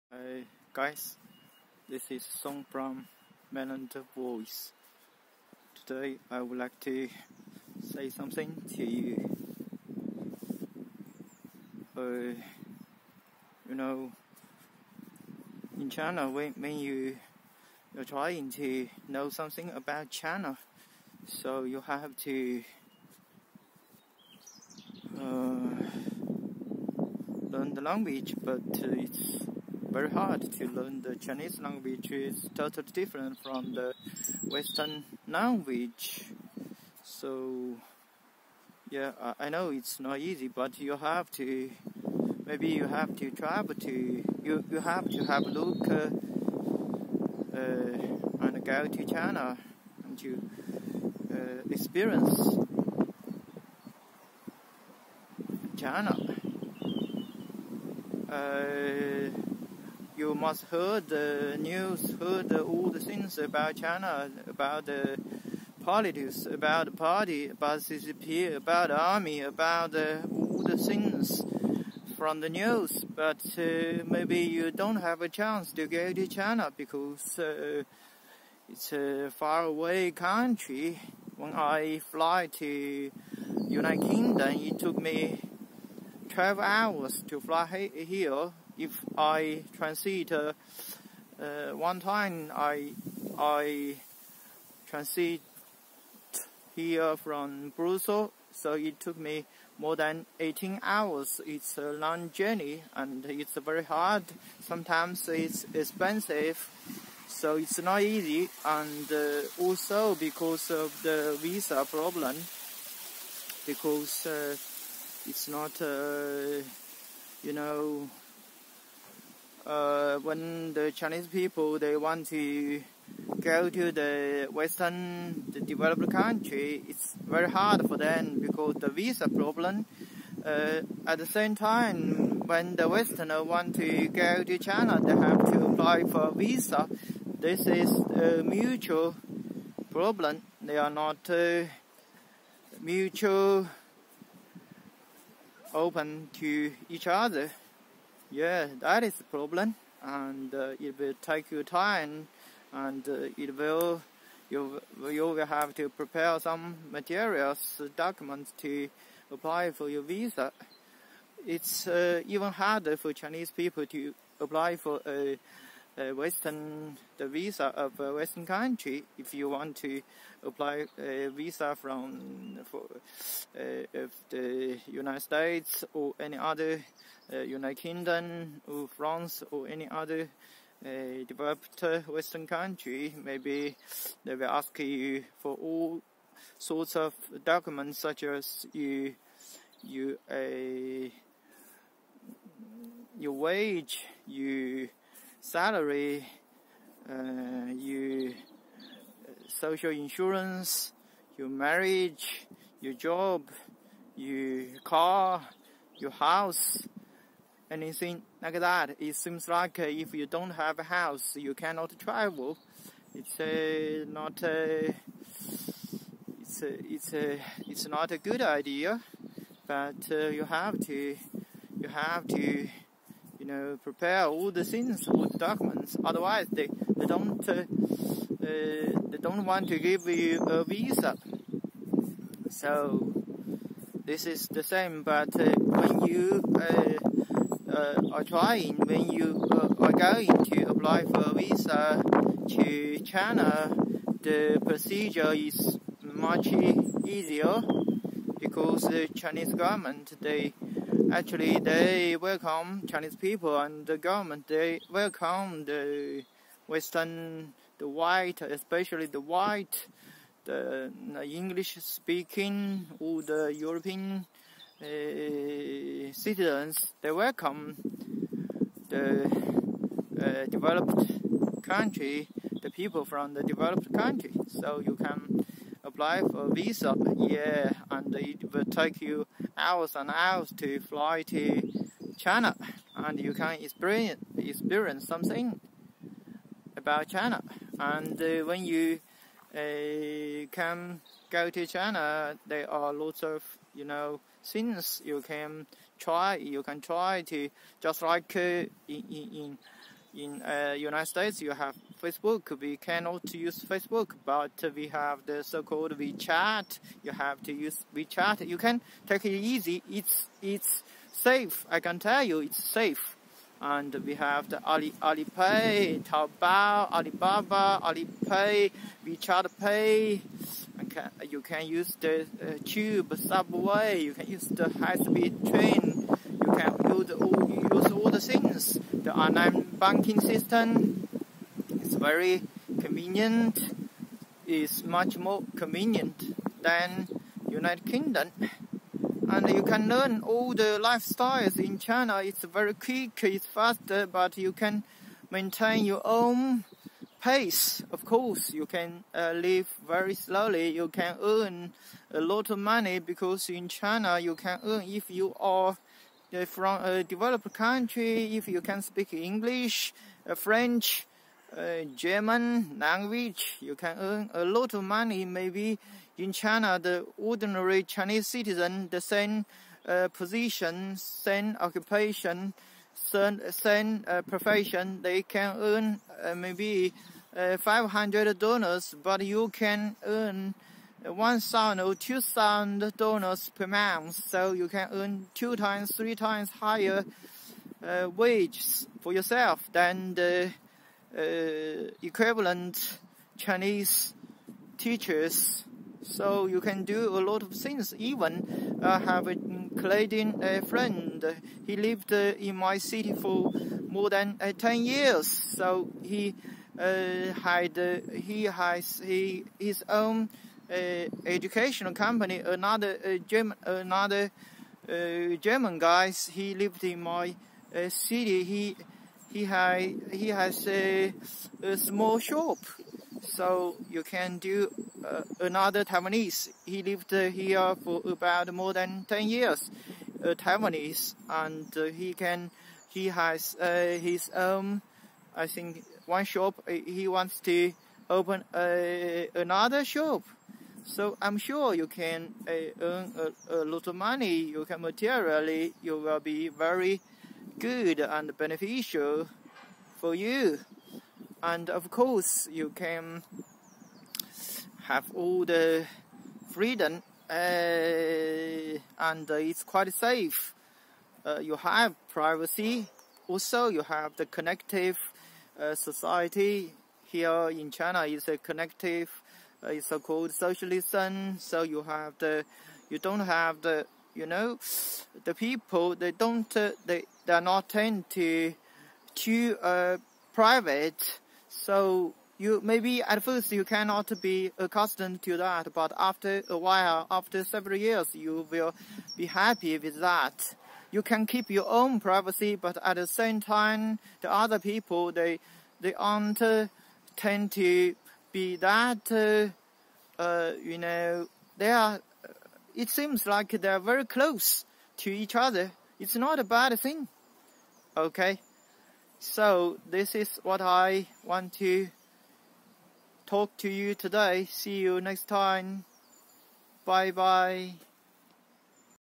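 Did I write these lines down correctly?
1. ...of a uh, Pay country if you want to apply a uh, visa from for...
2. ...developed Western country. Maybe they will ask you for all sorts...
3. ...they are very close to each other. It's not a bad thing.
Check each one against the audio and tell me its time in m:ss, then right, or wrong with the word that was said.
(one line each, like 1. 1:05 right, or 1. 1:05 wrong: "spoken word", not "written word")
1. 2:47 wrong: "Western", not "Pay"
2. 3:01 right
3. 8:23 right.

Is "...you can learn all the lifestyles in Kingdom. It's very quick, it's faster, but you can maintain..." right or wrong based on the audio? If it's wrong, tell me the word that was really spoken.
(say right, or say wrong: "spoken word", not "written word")
wrong: "China", not "Kingdom".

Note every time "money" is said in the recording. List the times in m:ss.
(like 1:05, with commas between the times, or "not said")
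5:52, 6:04, 7:23.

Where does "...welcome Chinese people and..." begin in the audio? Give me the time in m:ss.
4:12.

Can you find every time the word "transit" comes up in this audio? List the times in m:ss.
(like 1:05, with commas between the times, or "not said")
1:29, 1:34.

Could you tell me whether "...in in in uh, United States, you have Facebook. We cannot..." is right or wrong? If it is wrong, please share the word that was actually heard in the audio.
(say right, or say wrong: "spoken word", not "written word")
right.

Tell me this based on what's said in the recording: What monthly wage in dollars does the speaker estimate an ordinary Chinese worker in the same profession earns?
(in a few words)
$500.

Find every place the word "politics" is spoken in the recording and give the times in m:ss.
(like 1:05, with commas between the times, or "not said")
1:05.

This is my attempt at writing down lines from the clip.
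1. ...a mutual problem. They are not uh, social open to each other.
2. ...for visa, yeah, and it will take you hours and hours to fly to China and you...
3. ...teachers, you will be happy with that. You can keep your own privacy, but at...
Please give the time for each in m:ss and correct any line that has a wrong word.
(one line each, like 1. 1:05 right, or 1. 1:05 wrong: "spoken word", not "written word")
1. 2:18 wrong: "mutual", not "social"
2. 4:36 right
3. 8:07 wrong: "years", not "teachers".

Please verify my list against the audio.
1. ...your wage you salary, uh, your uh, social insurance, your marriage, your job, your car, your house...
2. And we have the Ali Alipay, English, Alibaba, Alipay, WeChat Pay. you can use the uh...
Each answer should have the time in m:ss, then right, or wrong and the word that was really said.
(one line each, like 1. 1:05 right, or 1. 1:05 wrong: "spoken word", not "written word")
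1. 3:13 right
2. 5:13 wrong: "Taobao", not "English".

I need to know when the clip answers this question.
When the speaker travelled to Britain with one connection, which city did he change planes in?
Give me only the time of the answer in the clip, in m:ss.
1:37.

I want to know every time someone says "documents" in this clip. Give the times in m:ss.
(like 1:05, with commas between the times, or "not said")
2:37, 3:07, 3:45.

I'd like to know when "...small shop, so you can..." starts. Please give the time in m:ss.
7:01.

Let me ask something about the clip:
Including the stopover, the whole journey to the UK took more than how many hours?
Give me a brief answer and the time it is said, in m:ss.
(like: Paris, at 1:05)
18 hours, at 1:40.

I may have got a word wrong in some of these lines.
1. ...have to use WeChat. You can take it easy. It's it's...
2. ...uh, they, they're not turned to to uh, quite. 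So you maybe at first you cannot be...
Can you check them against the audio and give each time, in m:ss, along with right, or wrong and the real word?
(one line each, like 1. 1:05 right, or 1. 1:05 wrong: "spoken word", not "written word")
1. 5:07 right
2. 7:56 wrong: "private", not "quite".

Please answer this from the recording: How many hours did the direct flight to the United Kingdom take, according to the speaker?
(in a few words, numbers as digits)
12 hours.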